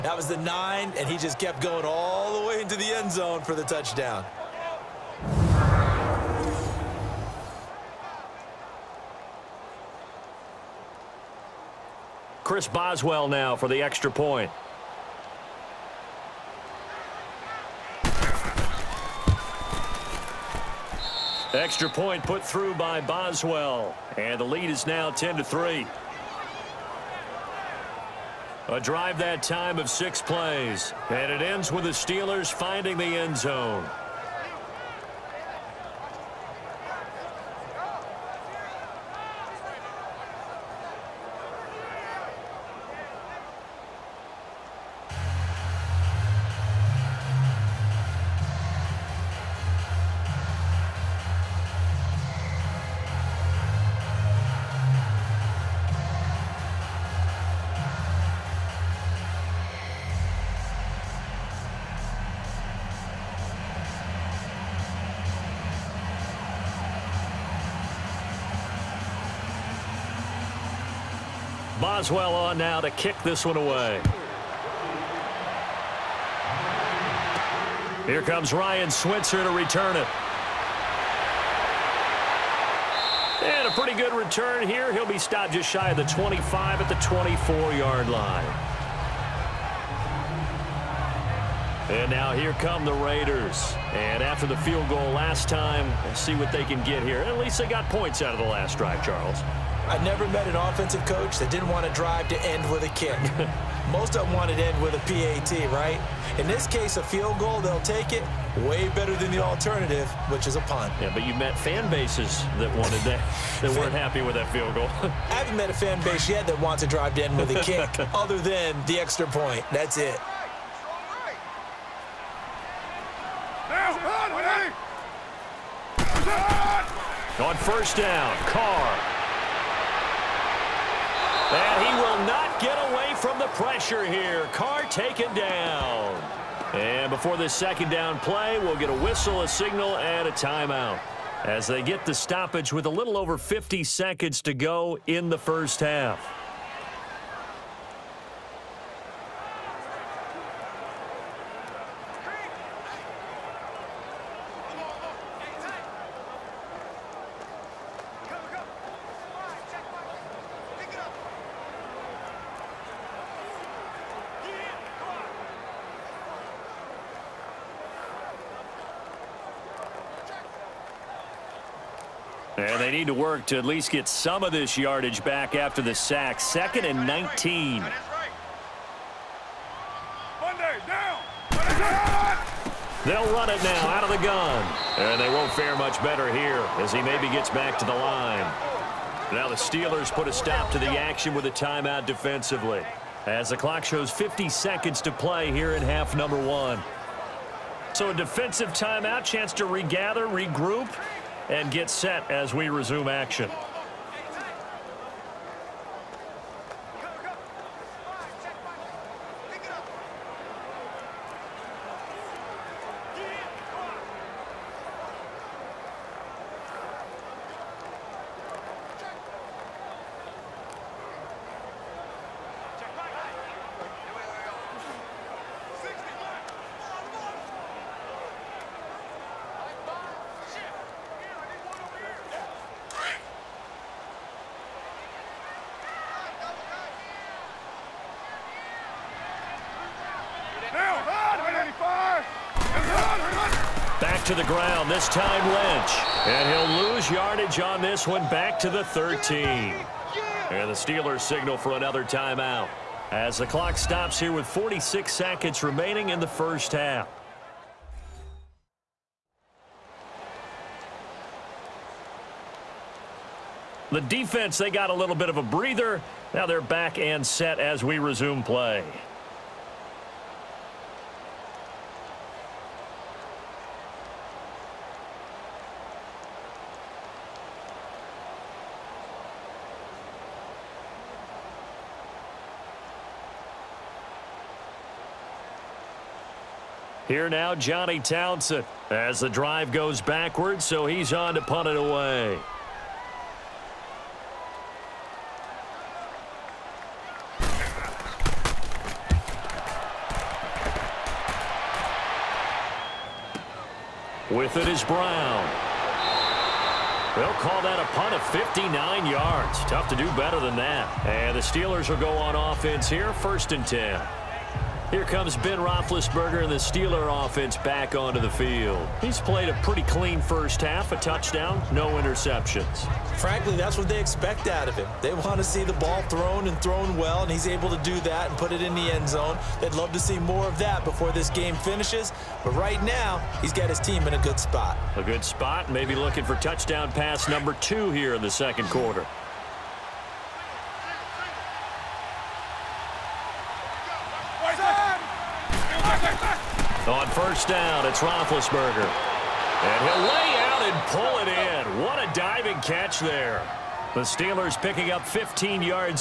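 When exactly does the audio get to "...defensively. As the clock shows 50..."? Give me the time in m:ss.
3:12.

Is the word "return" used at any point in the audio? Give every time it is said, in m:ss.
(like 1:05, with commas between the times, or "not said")
1:19, 1:24.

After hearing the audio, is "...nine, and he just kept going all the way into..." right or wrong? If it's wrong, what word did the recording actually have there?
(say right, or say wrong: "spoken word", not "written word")
right.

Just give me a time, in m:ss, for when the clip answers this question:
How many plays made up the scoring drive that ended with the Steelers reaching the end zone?
0:29.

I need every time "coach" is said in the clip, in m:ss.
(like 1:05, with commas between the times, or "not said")
1:41.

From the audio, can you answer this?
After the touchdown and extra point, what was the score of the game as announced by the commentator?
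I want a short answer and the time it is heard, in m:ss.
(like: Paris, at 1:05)
10 to 3, at 0:25.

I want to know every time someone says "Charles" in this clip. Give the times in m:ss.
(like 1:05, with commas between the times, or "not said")
1:39.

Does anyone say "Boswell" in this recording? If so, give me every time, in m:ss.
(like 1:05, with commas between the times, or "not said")
0:12, 0:23, 1:11.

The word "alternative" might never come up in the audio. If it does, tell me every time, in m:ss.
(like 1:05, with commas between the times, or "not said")
1:49.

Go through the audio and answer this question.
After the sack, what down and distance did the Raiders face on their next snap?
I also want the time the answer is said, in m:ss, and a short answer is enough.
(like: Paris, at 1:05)
Second and 19, at 2:56.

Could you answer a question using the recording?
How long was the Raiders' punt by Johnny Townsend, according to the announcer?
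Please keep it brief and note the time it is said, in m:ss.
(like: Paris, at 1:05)
59 yards, at 5:08.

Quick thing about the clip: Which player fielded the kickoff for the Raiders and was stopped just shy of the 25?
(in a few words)
Ryan Switzer.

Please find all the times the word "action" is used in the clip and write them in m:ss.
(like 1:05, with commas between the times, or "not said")
3:10, 3:23.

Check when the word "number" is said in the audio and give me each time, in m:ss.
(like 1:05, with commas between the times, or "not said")
3:16, 5:37.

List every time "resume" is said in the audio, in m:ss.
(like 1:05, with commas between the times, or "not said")
3:22, 4:27.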